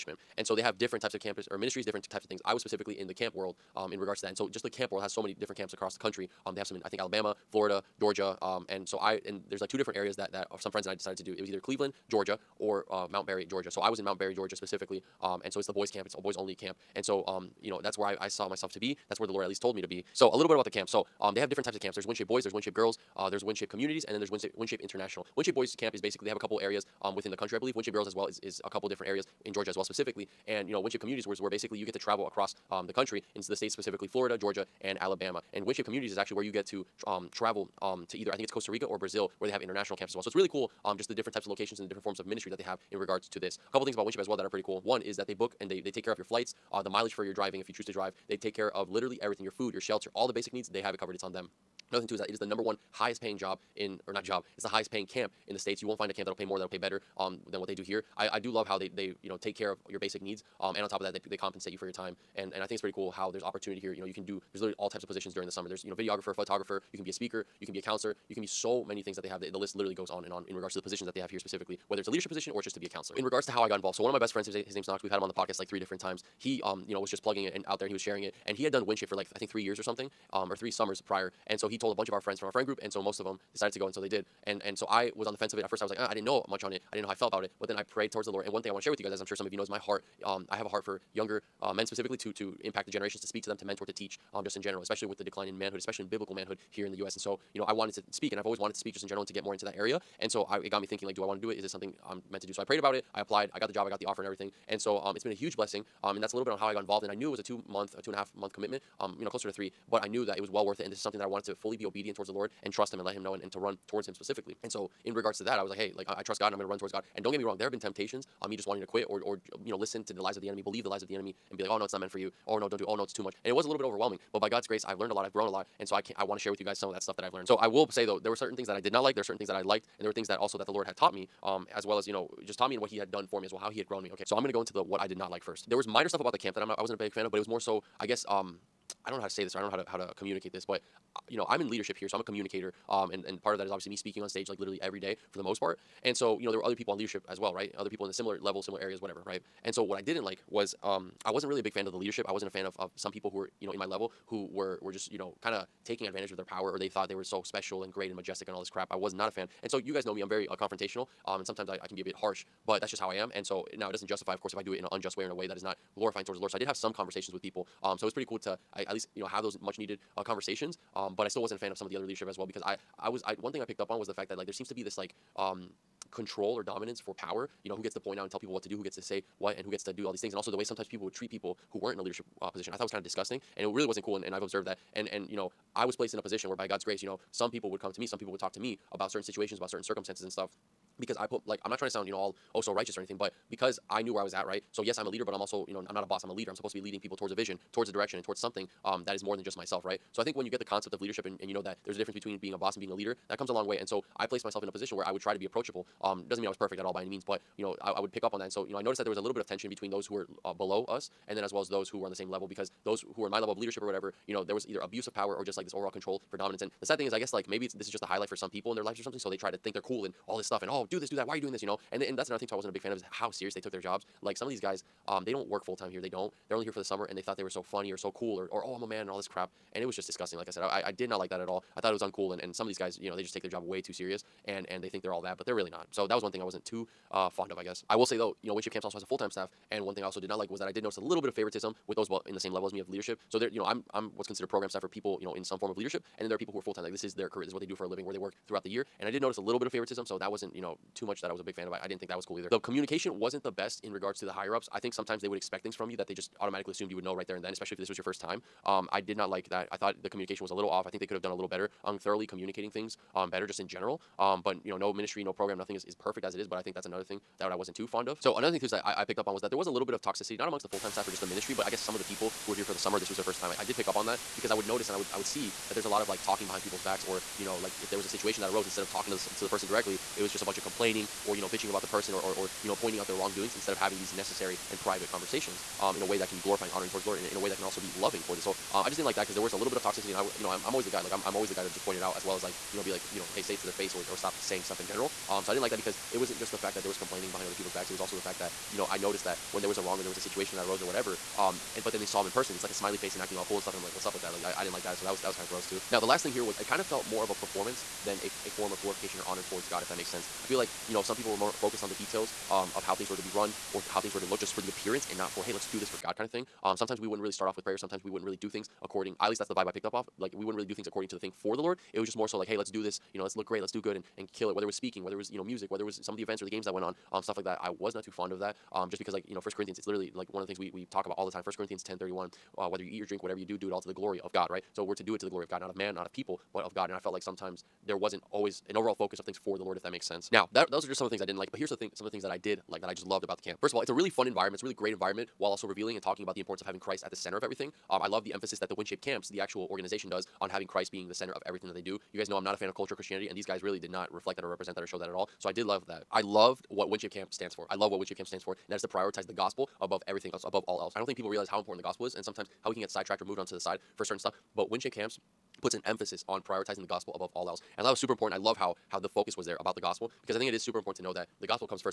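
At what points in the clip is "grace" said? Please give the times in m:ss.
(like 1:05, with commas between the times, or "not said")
2:04, 3:06.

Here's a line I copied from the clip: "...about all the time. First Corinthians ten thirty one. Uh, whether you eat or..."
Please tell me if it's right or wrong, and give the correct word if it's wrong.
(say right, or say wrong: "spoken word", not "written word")
right.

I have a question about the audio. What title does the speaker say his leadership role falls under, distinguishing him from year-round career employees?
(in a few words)
program staff.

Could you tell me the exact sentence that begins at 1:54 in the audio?
And so, in regards to that, I was like, hey, like I, I trust God and I'm going to run towards God.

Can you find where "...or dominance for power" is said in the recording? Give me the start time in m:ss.
2:56.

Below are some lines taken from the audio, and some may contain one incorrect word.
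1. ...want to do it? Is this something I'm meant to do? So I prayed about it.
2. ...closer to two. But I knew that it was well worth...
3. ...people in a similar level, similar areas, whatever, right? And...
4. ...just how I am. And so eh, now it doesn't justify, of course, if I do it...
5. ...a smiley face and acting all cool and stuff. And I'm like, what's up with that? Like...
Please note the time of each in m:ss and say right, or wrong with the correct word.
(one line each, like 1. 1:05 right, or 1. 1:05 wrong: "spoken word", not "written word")
1. 1:41 right
2. 1:49 wrong: "three", not "two"
3. 2:27 right
4. 2:42 right
5. 5:02 right.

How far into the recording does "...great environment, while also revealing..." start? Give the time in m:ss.
5:44.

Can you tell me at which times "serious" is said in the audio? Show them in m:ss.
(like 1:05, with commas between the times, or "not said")
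3:43, 3:53.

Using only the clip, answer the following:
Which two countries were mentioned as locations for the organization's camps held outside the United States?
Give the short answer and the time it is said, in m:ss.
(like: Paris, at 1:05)
Costa Rica or Brazil, at 0:38.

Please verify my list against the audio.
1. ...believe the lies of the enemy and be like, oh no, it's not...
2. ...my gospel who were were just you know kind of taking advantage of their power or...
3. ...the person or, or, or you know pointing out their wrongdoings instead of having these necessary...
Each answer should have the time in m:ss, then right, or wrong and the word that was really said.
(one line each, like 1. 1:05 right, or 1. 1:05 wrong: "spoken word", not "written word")
1. 2:00 right
2. 2:33 wrong: "level", not "gospel"
3. 4:41 right.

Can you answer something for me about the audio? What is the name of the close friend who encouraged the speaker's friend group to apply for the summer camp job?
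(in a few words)
Knox.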